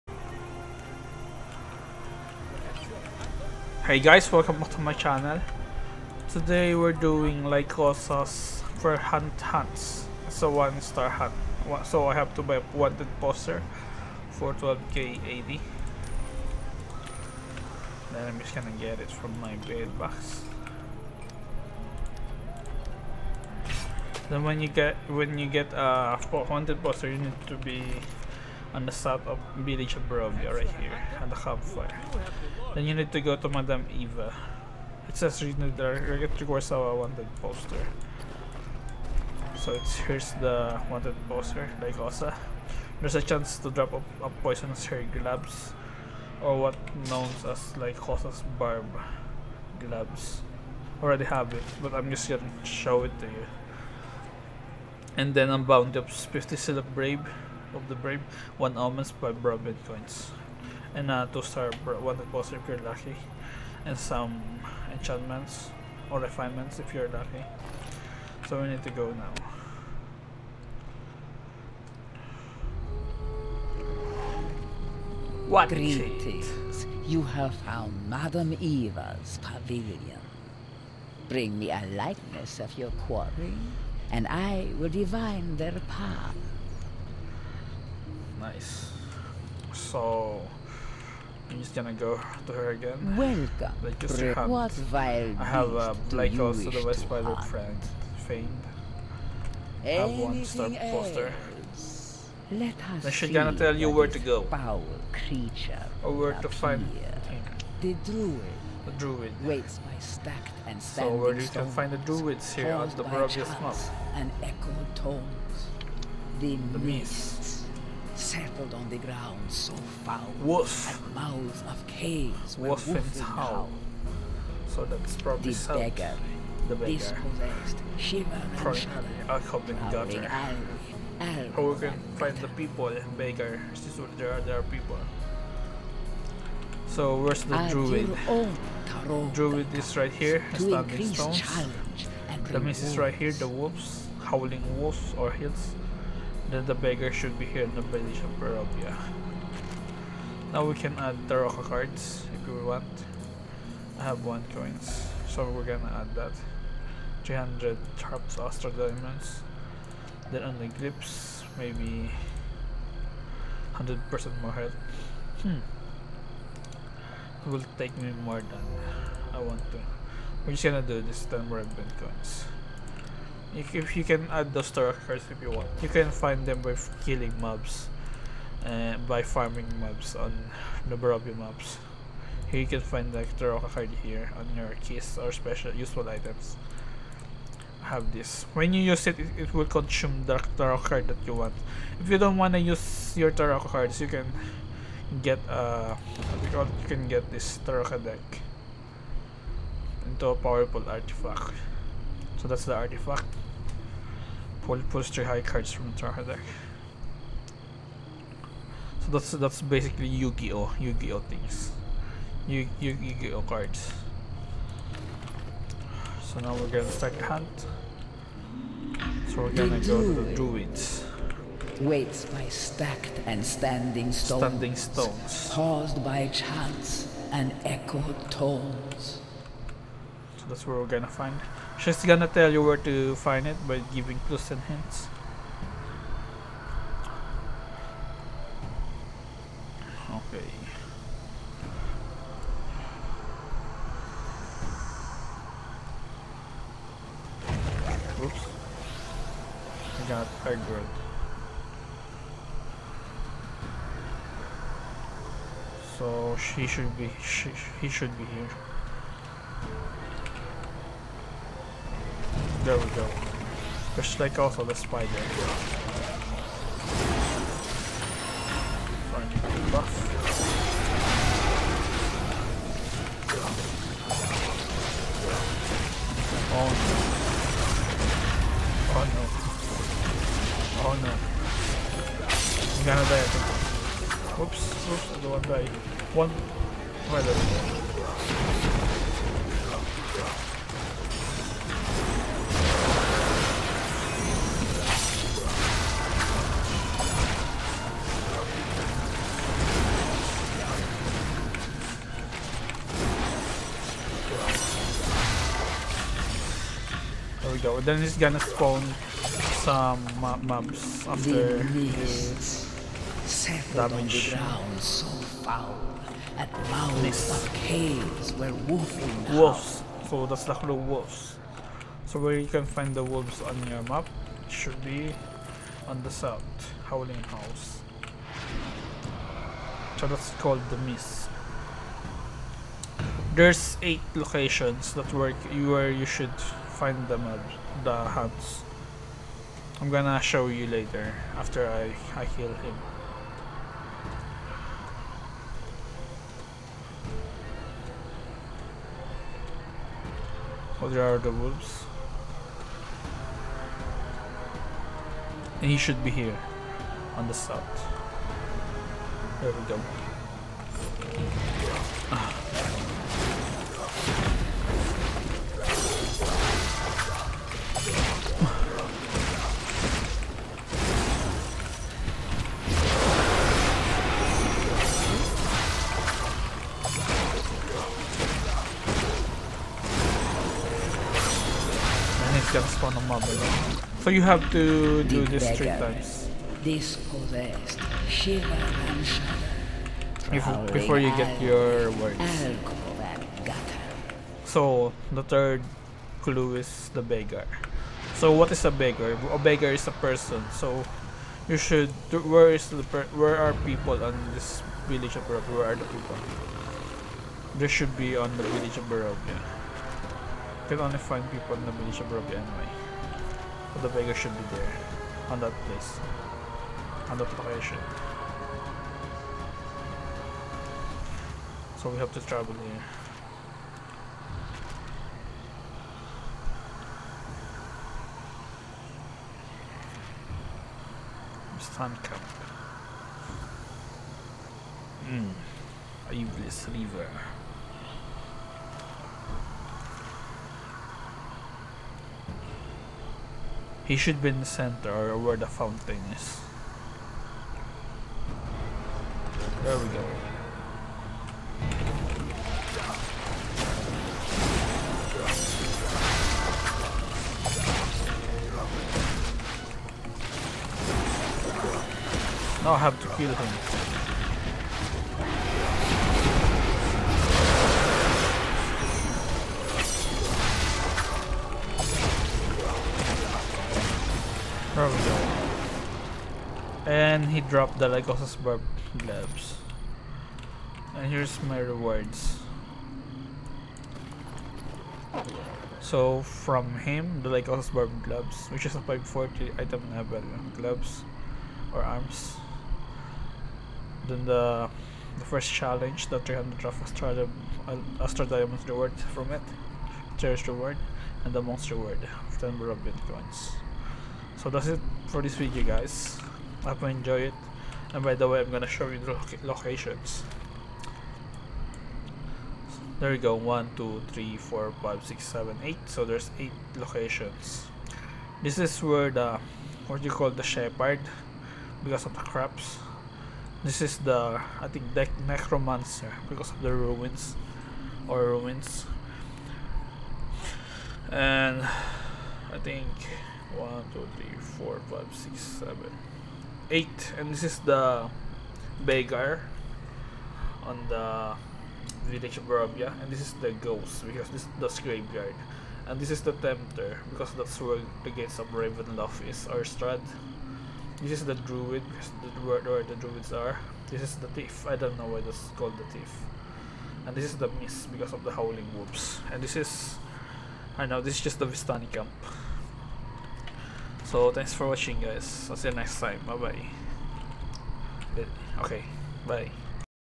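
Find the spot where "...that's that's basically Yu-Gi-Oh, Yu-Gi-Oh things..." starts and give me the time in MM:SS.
03:29.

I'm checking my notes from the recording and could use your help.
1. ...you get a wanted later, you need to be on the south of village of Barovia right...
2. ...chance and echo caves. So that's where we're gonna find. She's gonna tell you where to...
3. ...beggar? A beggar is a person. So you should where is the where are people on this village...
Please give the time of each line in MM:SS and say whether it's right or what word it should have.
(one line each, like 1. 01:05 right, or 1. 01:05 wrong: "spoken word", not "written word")
1. 00:25 wrong: "poster", not "later"
2. 03:46 wrong: "tones", not "caves"
3. 06:38 right.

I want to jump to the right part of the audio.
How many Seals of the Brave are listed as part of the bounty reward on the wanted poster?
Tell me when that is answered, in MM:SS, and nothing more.
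00:56.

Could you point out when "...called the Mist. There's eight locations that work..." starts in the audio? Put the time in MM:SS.
05:30.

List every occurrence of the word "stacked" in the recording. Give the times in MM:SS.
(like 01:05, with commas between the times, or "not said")
01:49, 03:42.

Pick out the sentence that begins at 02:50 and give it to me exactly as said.
We're just gonna do this time red coins if you can add those star cards if you want.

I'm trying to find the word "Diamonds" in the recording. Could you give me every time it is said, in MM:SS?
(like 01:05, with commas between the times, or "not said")
02:38, 08:18.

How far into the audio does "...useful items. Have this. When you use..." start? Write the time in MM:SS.
03:05.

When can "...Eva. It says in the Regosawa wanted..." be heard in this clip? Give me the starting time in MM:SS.
00:33.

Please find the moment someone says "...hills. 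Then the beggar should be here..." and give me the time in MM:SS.
02:25.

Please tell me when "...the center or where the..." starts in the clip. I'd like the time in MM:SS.
07:24.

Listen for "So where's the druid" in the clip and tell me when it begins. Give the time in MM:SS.
02:16.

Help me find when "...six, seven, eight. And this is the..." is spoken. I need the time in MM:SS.
08:55.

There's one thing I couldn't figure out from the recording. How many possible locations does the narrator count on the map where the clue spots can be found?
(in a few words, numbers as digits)
8.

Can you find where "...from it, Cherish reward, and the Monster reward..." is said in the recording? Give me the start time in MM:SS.
08:19.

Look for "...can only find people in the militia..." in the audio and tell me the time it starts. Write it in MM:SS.
06:50.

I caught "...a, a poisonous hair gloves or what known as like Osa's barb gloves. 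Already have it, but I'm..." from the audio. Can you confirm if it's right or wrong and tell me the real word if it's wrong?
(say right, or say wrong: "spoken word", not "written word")
right.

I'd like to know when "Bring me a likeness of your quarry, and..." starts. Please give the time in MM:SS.
01:21.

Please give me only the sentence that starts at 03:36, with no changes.
So now we're gonna start the hunt.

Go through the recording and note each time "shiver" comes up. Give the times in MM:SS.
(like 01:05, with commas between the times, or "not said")
02:07, 06:28.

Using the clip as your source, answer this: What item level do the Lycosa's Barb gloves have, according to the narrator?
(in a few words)
540.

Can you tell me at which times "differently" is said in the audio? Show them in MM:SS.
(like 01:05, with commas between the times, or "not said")
not said.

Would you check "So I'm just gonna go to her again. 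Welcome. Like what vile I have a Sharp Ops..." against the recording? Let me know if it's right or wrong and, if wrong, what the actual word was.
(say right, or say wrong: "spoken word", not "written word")
wrong: "Black", not "Sharp".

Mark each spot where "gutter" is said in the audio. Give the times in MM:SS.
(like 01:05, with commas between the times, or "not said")
02:09.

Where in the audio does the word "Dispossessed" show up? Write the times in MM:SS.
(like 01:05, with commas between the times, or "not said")
02:06, 06:26.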